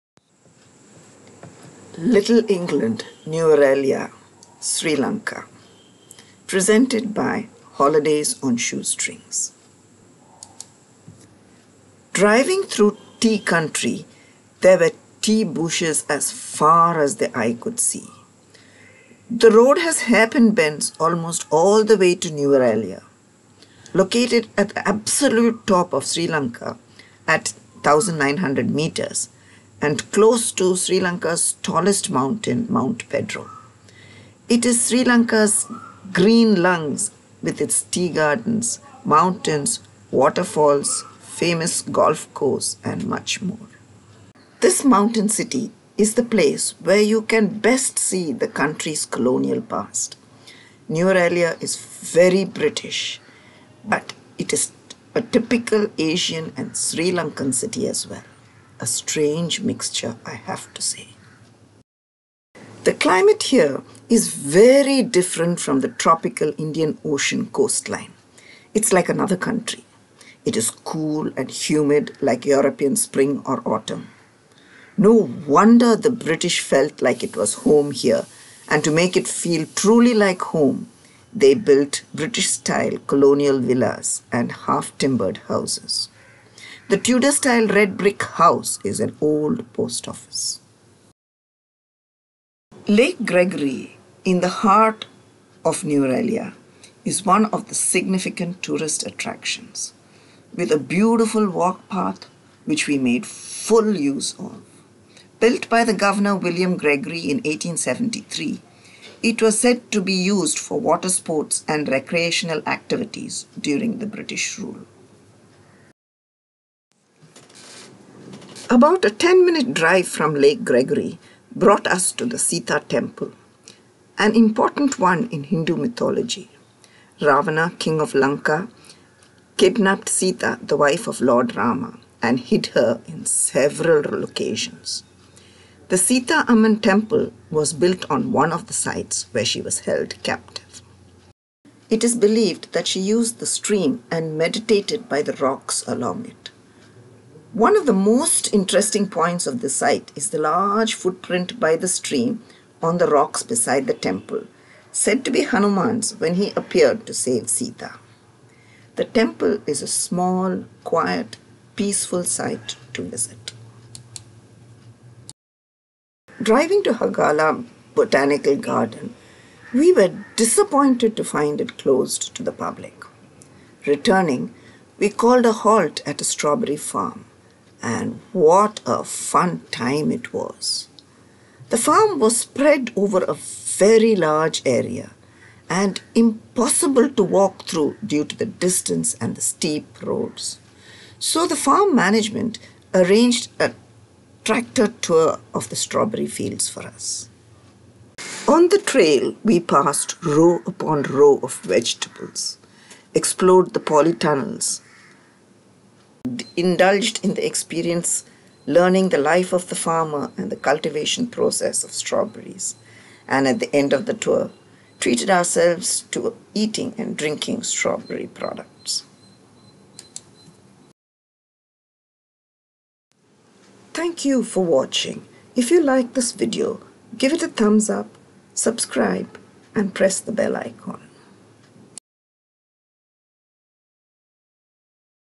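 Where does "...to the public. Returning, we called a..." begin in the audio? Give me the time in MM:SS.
02:52.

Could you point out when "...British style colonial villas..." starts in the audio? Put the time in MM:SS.
01:22.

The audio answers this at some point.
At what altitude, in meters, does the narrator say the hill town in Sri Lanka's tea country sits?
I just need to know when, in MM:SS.
00:27.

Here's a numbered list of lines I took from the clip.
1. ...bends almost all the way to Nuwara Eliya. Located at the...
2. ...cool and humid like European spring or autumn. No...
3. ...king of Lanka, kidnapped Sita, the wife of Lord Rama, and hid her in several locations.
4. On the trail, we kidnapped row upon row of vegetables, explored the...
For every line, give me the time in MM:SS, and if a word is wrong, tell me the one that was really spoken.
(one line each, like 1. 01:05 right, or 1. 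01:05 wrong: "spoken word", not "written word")
1. 00:20 right
2. 01:10 right
3. 02:07 right
4. 03:18 wrong: "passed", not "kidnapped".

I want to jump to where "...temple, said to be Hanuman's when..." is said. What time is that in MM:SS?
02:33.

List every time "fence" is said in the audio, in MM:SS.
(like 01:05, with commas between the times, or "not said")
not said.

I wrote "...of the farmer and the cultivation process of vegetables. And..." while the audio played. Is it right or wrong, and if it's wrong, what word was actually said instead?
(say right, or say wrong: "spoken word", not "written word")
wrong: "strawberries", not "vegetables".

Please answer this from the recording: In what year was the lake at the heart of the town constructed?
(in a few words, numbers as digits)
1873.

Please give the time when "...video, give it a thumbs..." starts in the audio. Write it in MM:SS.
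03:46.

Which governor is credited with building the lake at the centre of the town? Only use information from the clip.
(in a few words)
William Gregory.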